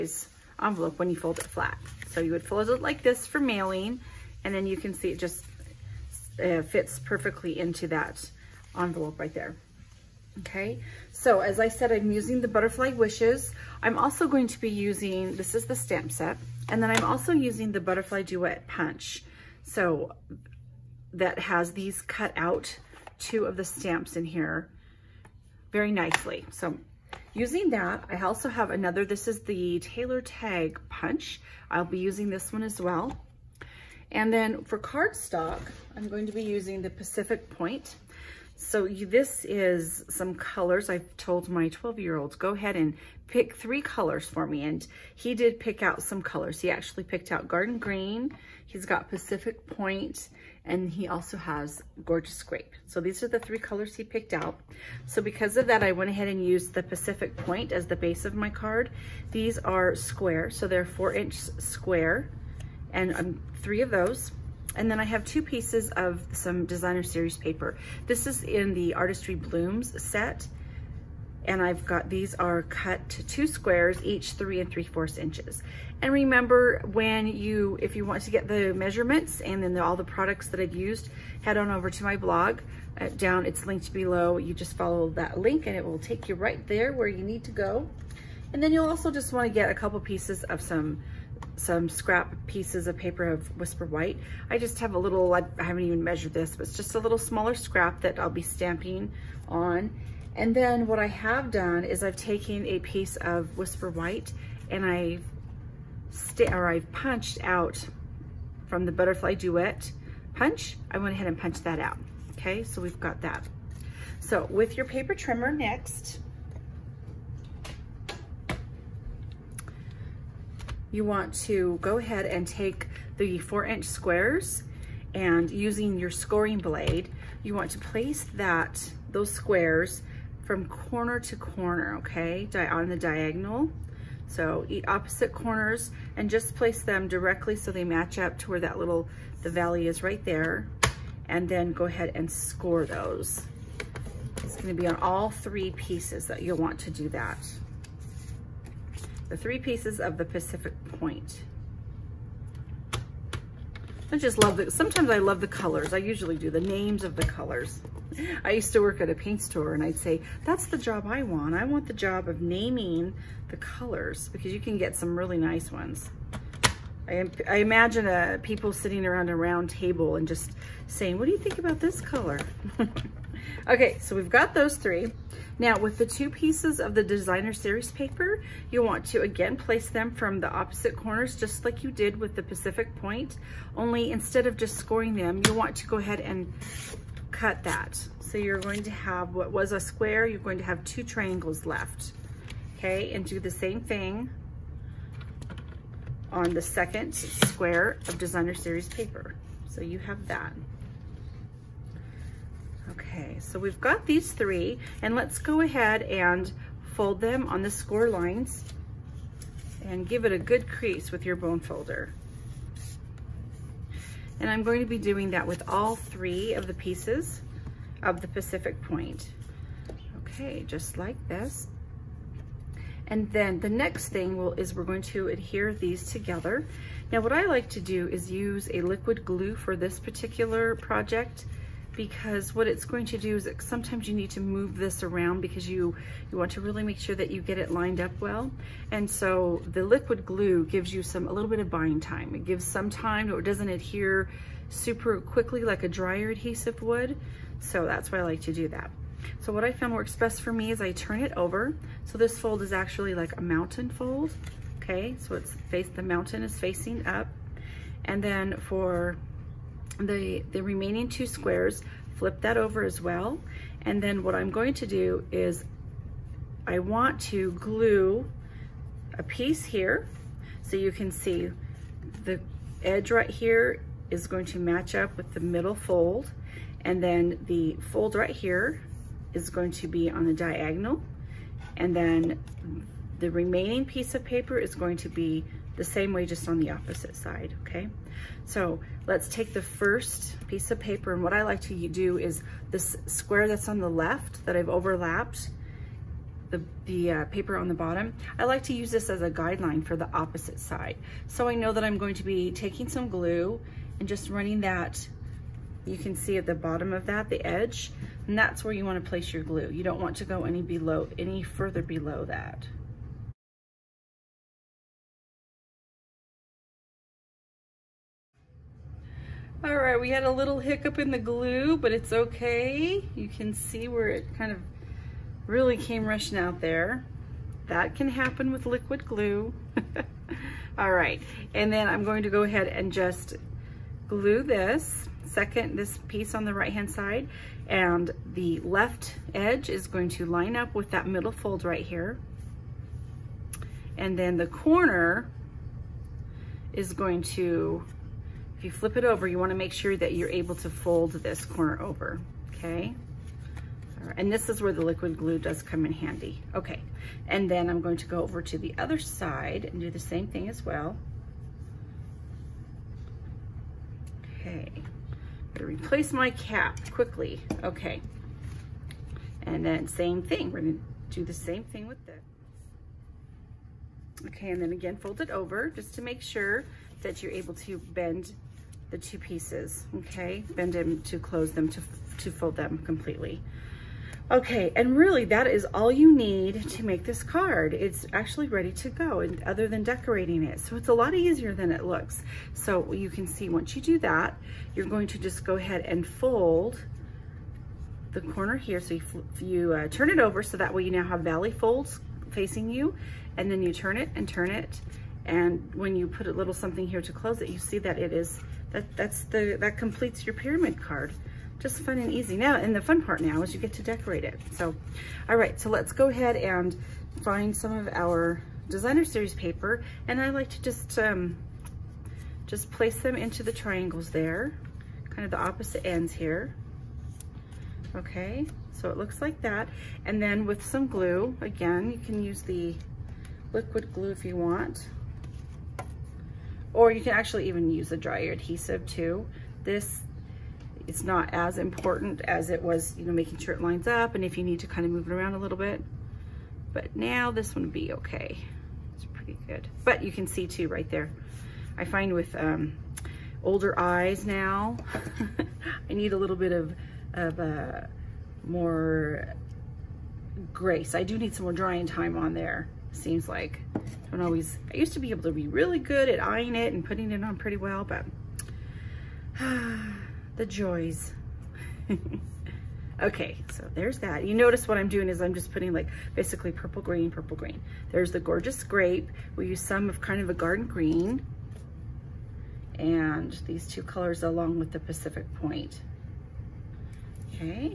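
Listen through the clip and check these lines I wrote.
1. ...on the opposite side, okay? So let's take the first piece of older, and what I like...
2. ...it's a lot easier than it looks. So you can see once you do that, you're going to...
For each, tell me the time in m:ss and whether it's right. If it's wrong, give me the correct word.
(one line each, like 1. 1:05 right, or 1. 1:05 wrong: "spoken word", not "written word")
1. 4:46 wrong: "paper", not "older"
2. 6:30 right.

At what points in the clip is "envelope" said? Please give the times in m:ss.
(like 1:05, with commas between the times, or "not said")
0:00, 0:08.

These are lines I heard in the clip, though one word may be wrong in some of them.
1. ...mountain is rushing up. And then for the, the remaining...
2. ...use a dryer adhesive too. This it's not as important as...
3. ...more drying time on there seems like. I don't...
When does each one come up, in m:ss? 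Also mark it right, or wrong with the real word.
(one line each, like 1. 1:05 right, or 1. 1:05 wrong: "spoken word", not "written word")
1. 4:16 wrong: "facing", not "rushing"
2. 7:17 right
3. 7:41 right.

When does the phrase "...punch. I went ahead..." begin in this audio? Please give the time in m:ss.
1:50.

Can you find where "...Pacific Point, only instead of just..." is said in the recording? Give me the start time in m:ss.
3:02.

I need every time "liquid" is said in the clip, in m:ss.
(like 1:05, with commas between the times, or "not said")
3:48, 3:59, 5:28, 5:54, 7:13.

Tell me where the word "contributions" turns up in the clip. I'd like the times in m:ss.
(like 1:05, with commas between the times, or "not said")
not said.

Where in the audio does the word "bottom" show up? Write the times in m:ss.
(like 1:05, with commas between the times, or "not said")
4:57, 5:06.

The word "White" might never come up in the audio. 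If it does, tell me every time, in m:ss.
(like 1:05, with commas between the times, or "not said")
1:33, 1:43.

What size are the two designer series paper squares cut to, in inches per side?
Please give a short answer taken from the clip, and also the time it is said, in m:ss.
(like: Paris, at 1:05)
3 3/4 inches, at 1:14.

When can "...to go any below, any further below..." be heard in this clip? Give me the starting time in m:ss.
5:10.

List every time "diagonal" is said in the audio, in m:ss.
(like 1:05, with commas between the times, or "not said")
2:12, 4:40.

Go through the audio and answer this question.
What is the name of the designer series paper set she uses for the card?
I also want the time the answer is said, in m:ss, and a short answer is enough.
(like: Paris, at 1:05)
Artistry Blooms, at 1:08.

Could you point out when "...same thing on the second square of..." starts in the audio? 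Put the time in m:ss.
3:13.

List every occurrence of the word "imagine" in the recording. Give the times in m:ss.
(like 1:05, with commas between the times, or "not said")
2:47.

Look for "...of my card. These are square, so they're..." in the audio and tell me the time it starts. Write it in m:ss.
0:58.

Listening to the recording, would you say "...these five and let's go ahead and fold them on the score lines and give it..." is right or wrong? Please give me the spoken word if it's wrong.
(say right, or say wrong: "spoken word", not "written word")
wrong: "three", not "five".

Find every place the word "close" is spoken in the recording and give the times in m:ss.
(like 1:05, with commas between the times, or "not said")
6:21, 6:47.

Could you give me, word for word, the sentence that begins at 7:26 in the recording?
But now this one would be okay.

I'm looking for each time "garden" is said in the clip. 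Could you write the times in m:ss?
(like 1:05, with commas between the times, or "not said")
0:47, 8:00.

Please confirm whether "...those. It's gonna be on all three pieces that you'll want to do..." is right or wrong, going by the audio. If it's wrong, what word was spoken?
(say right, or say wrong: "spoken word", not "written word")
right.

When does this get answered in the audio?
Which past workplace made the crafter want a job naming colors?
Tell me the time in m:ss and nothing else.
2:39.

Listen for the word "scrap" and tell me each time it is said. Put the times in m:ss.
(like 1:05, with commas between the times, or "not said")
1:31, 1:37.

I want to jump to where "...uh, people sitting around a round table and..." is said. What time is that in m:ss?
2:48.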